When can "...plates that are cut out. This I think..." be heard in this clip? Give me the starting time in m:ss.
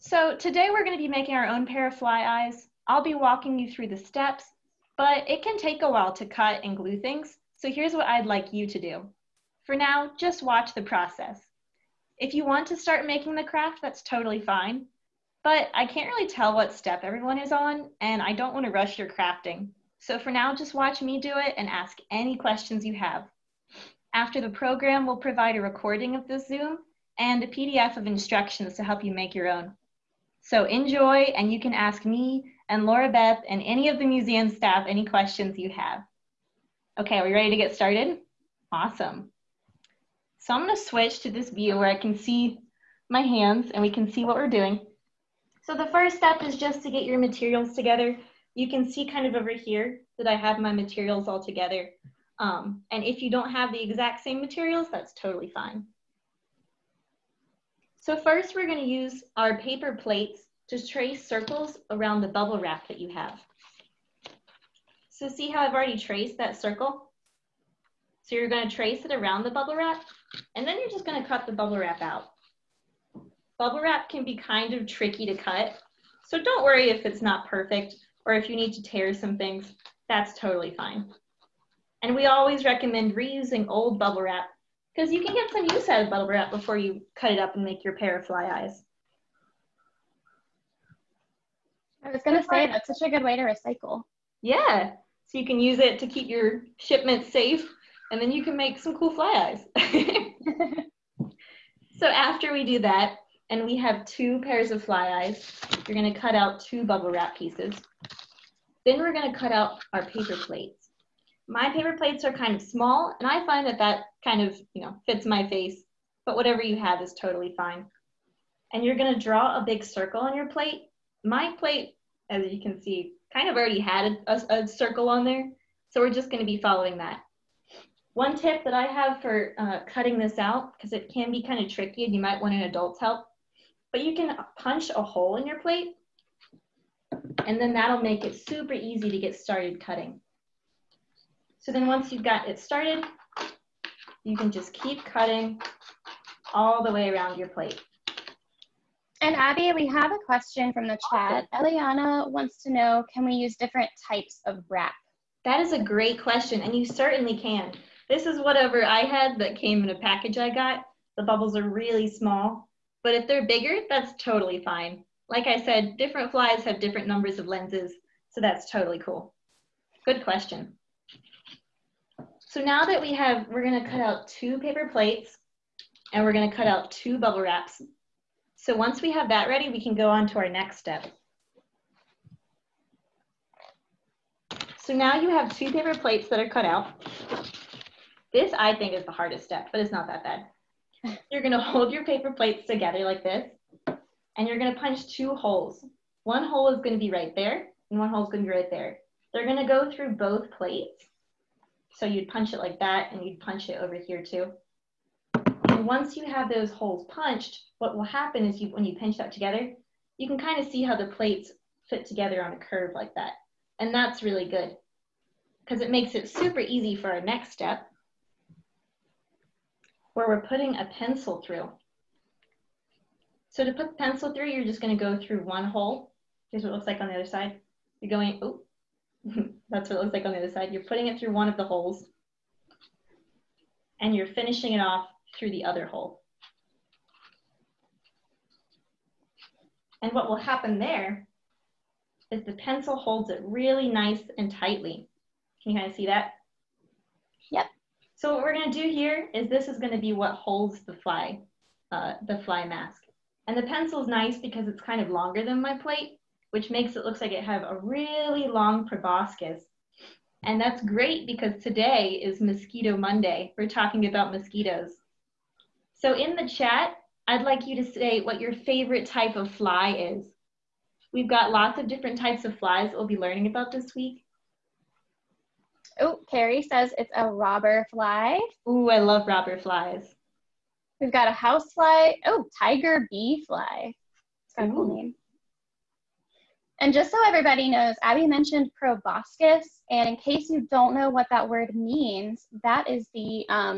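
3:05.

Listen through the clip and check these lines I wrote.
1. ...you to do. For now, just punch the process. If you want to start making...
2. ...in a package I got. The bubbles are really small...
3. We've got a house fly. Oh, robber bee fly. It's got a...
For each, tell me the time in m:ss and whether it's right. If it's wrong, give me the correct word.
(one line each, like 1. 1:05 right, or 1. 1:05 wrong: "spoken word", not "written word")
1. 0:08 wrong: "watch", not "punch"
2. 2:39 right
3. 4:40 wrong: "tiger", not "robber".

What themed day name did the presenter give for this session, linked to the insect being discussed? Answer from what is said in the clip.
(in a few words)
Mosquito Monday.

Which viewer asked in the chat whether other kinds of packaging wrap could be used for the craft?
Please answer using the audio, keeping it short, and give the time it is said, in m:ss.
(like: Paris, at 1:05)
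Eliana, at 2:31.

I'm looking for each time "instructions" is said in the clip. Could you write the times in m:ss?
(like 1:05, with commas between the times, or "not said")
0:28.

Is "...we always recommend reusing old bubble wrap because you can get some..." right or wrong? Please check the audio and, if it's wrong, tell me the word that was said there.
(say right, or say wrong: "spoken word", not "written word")
right.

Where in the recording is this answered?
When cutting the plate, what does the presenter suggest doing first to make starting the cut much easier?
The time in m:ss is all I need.
2:14.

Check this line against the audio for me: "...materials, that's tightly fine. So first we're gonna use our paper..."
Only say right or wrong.
wrong.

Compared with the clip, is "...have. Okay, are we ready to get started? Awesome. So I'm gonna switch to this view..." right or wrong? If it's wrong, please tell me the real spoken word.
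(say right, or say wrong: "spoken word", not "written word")
right.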